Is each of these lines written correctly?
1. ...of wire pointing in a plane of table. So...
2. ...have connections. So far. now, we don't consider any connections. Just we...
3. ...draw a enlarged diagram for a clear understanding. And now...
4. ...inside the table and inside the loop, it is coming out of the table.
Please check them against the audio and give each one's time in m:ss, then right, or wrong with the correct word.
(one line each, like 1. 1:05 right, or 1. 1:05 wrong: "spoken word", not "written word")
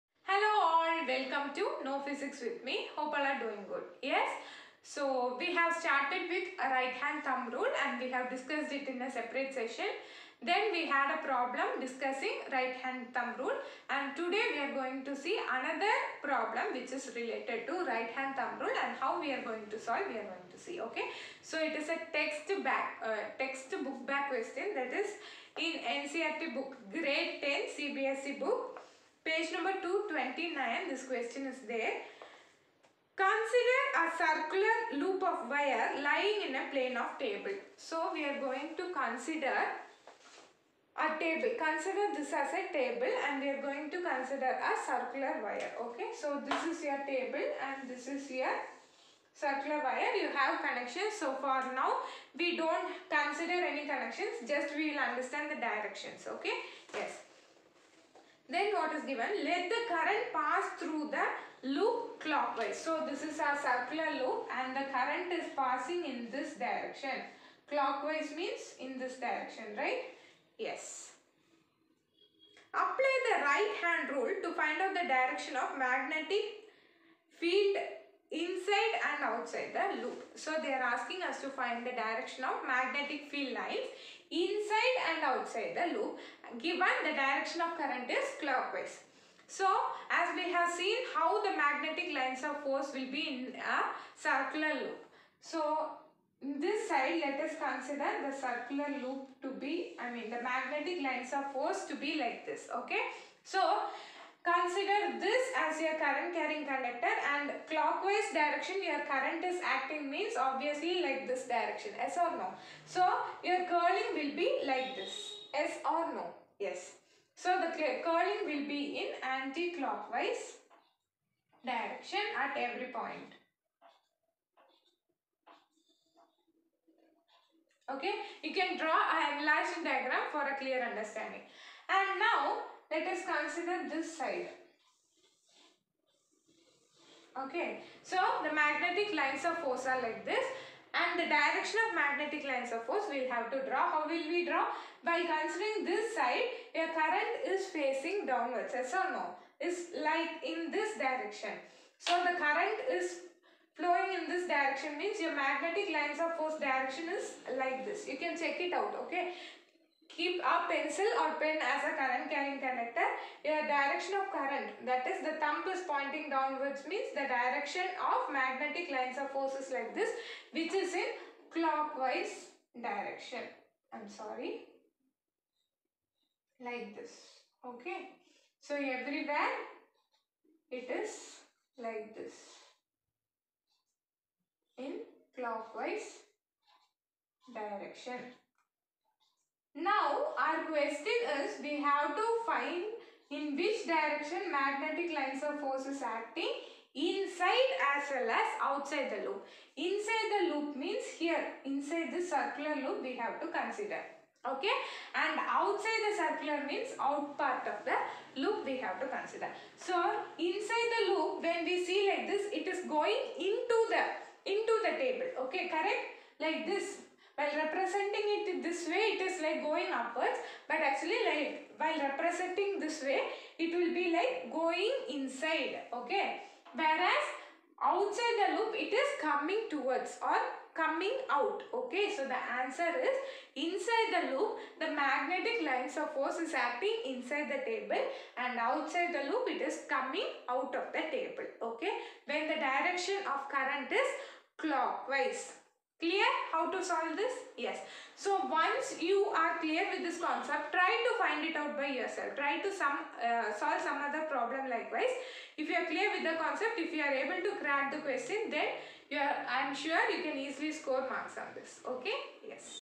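1. 0:35 wrong: "lying", not "pointing"
2. 0:50 right
3. 2:08 right
4. 3:57 wrong: "outside", not "inside".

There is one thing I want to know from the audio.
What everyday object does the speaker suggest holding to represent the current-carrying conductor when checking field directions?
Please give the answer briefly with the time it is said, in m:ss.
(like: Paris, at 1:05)
Pencil or pen, at 2:40.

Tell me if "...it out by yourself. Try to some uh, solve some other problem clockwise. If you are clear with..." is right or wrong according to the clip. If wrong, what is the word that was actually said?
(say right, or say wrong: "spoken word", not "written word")
wrong: "likewise", not "clockwise".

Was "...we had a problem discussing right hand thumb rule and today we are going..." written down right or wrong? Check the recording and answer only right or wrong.
right.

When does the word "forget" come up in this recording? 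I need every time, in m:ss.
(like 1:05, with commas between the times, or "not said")
not said.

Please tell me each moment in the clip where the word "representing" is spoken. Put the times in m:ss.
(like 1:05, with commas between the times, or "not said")
3:37, 3:41.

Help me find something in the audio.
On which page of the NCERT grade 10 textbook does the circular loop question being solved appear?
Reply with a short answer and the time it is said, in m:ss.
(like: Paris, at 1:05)
229, at 0:29.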